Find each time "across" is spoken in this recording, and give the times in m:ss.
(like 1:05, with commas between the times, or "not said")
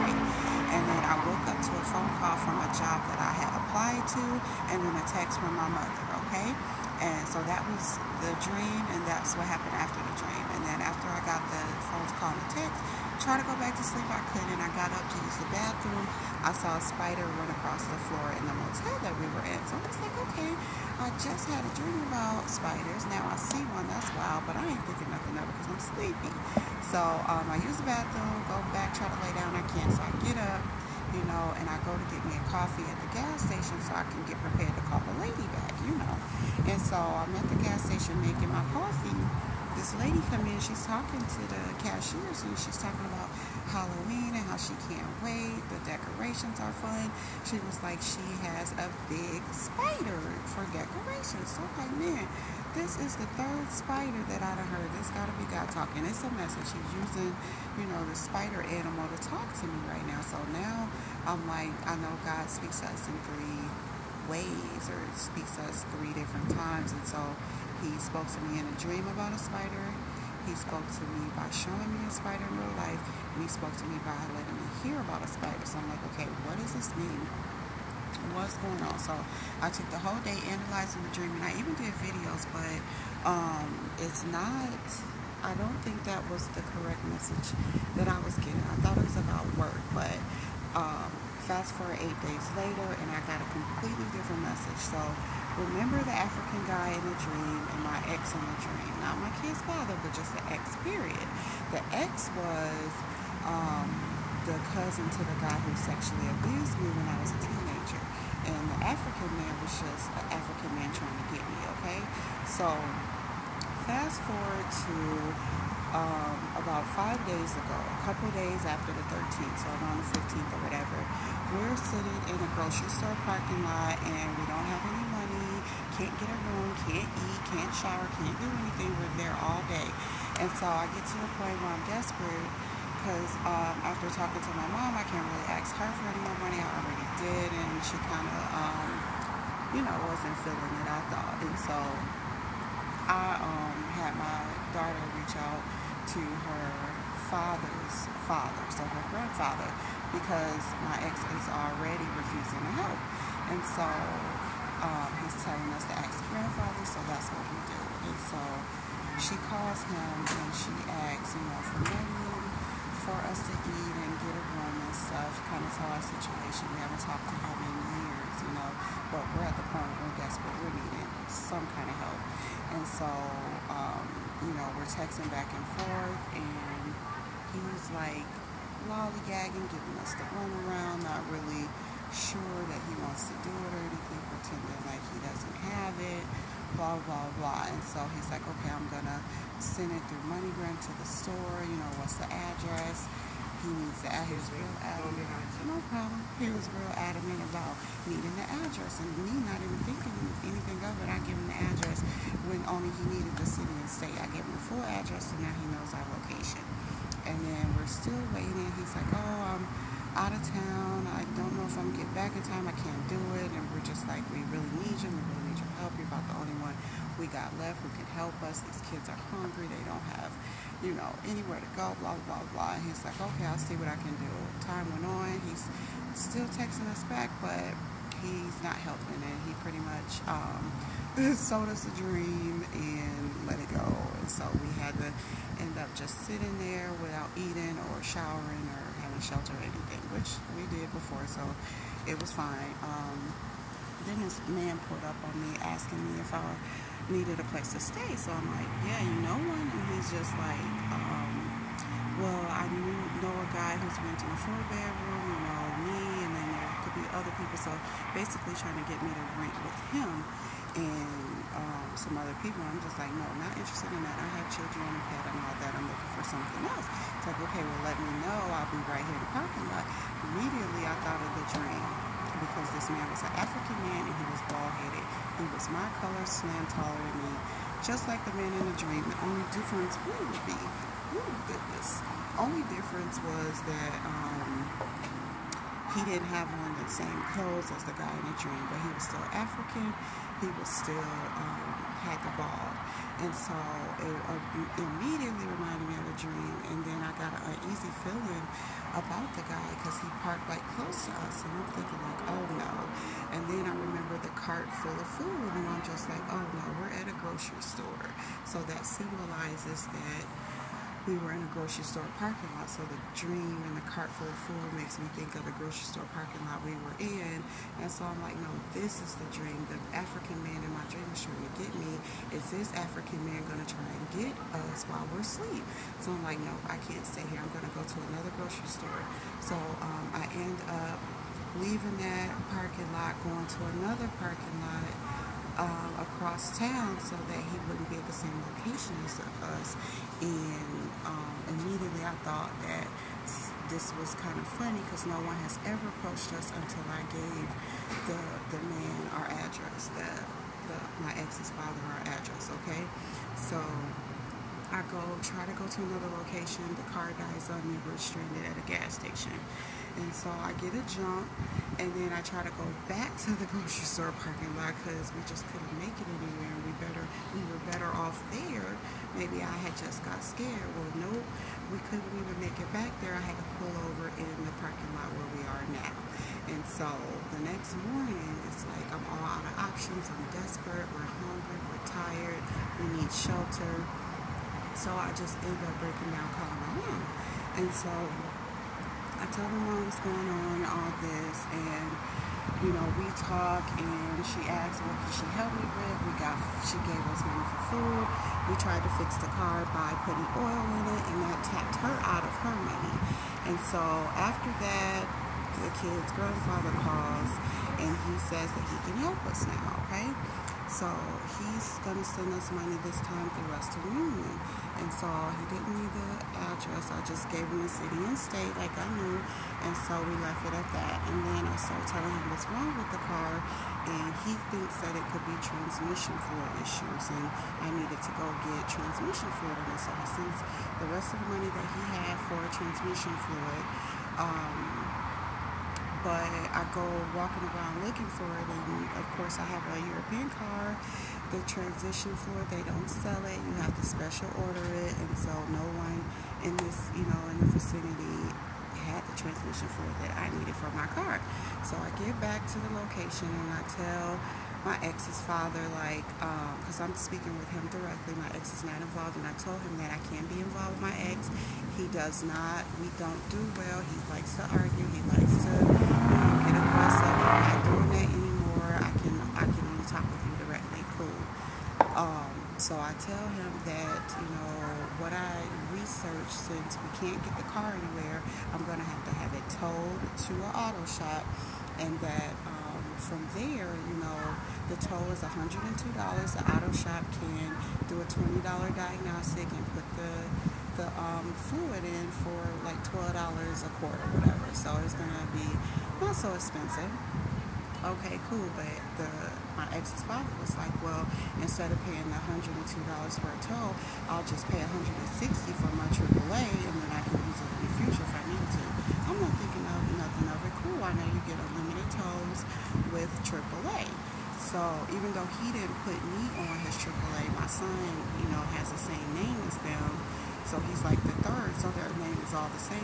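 0:17, 5:35.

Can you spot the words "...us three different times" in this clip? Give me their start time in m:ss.
1:05.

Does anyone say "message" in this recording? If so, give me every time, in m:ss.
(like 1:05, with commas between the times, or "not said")
0:56, 1:27, 1:34.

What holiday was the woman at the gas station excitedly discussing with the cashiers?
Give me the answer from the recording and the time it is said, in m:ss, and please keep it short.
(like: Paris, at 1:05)
Halloween, at 0:43.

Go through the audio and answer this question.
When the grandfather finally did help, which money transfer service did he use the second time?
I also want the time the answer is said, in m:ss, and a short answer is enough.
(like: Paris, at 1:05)
Western Union, at 6:53.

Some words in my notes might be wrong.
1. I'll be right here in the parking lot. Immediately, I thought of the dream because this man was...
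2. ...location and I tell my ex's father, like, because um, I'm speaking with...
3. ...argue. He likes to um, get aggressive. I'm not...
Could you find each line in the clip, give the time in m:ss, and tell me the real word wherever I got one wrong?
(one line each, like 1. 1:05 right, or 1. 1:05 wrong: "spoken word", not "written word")
1. 4:28 right
2. 7:32 right
3. 7:44 right.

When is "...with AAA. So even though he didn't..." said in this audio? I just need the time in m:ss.
8:32.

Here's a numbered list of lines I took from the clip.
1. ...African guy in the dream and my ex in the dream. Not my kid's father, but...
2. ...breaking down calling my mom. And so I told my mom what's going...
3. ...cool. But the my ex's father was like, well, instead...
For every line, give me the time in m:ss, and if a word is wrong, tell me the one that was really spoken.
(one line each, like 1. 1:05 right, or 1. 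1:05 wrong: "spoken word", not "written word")
1. 1:36 right
2. 6:25 right
3. 8:18 right.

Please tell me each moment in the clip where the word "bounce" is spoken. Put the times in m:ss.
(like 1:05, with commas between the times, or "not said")
not said.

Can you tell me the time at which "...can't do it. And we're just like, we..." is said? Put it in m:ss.
3:32.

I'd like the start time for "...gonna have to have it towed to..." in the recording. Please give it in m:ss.
7:58.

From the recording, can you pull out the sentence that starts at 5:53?
So I go try to go to another location.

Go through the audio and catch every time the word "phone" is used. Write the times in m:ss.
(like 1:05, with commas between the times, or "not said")
0:01, 0:11.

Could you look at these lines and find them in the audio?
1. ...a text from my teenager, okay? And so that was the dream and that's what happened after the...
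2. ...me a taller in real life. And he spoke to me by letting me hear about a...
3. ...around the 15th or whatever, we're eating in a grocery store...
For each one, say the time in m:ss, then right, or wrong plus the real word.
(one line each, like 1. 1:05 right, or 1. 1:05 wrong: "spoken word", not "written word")
1. 0:04 wrong: "mother", not "teenager"
2. 1:11 wrong: "spider", not "taller"
3. 1:59 wrong: "sitting", not "eating".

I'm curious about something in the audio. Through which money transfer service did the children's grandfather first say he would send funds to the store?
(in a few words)
MoneyGram.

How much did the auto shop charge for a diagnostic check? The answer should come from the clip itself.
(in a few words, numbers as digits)
$20.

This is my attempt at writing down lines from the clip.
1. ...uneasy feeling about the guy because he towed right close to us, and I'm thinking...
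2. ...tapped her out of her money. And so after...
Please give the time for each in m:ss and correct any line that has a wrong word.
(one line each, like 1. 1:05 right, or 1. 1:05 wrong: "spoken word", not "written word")
1. 4:57 wrong: "parked", not "towed"
2. 6:41 right.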